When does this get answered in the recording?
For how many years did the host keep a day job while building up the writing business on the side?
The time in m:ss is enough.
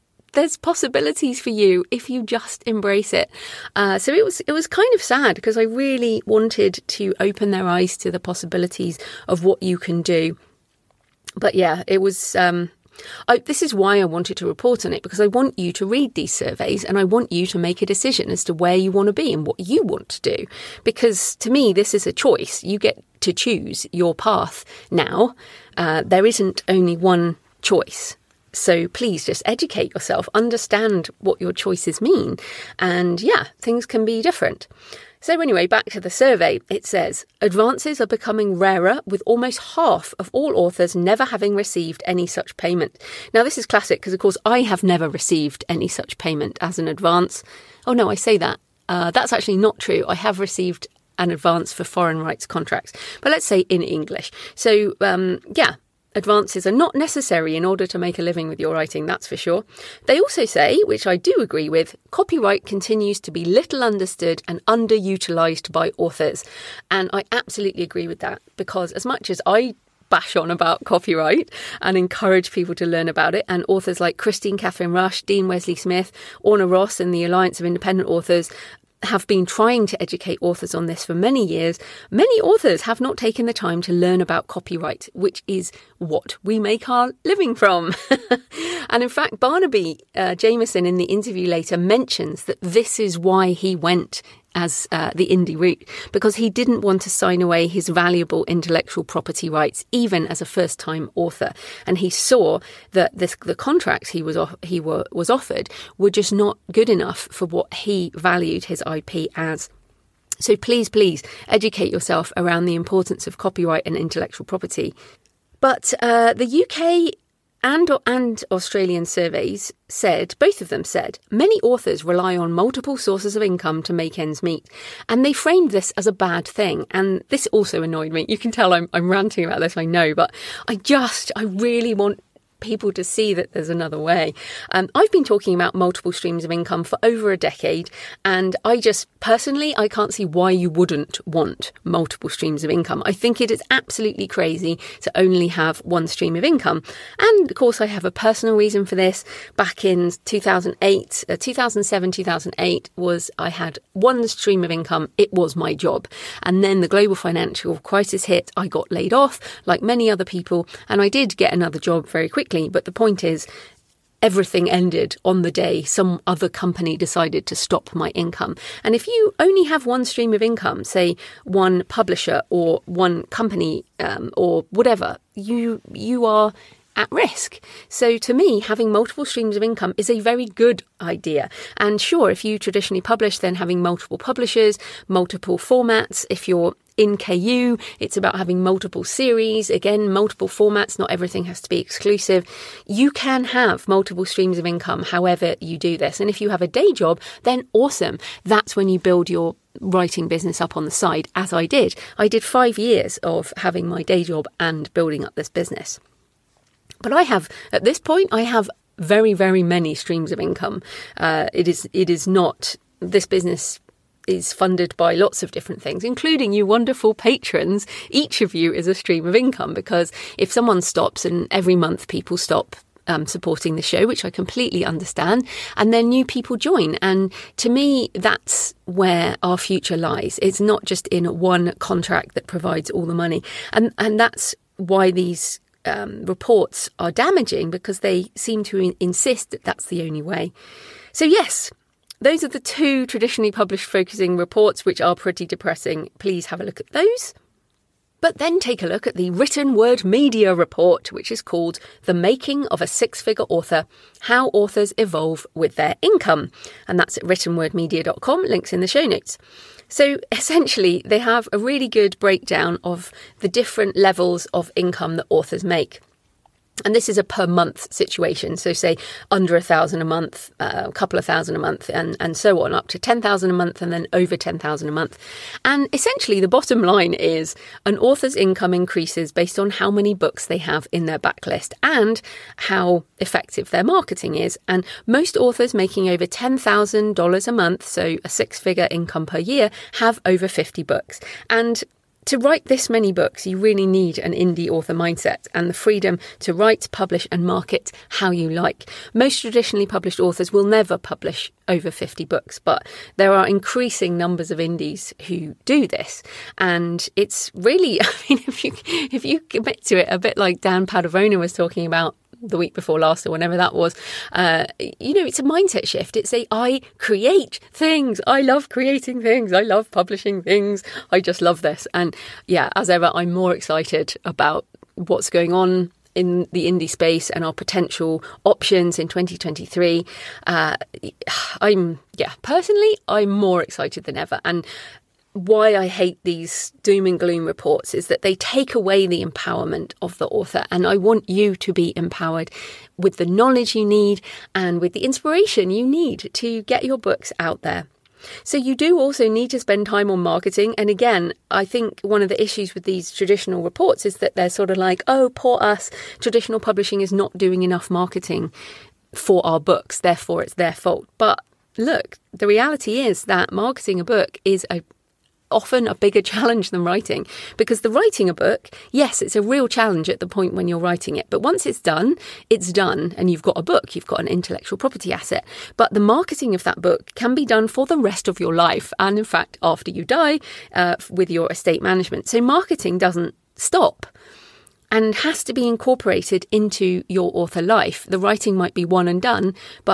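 3:22.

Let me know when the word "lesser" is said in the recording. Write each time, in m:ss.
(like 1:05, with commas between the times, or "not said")
not said.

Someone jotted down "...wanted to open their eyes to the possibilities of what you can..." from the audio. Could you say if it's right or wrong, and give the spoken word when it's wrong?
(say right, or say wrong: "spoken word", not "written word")
right.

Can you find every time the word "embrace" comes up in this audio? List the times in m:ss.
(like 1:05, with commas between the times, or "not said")
0:02.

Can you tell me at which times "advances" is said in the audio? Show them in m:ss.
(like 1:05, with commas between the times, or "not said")
0:37, 0:46, 0:51, 0:56.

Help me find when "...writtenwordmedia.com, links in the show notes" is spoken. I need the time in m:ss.
4:17.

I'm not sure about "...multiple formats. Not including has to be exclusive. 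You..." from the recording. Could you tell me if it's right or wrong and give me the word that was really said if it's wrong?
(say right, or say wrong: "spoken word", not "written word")
wrong: "everything", not "including".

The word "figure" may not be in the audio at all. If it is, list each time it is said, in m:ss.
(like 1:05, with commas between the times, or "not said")
4:13, 4:48.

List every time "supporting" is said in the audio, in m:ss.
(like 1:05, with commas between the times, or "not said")
3:43.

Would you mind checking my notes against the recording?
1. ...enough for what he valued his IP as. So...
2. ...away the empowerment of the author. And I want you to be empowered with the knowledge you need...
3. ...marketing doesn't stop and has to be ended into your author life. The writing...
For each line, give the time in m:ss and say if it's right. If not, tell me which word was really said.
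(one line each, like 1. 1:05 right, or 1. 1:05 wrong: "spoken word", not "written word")
1. 1:46 right
2. 5:38 right
3. 6:22 wrong: "incorporated", not "ended".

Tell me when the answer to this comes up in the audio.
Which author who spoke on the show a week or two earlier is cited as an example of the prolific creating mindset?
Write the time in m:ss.
5:10.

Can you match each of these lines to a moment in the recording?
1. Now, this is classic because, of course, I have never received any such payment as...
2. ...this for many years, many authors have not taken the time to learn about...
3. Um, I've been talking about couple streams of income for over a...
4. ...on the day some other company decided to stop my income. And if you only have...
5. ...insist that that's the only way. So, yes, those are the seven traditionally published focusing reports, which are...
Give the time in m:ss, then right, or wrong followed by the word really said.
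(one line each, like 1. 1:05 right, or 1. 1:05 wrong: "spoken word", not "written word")
1. 0:43 right
2. 1:20 right
3. 2:14 wrong: "multiple", not "couple"
4. 2:45 right
5. 3:58 wrong: "two", not "seven".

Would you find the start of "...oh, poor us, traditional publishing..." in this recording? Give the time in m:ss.
5:55.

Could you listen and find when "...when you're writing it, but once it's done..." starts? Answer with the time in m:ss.
6:10.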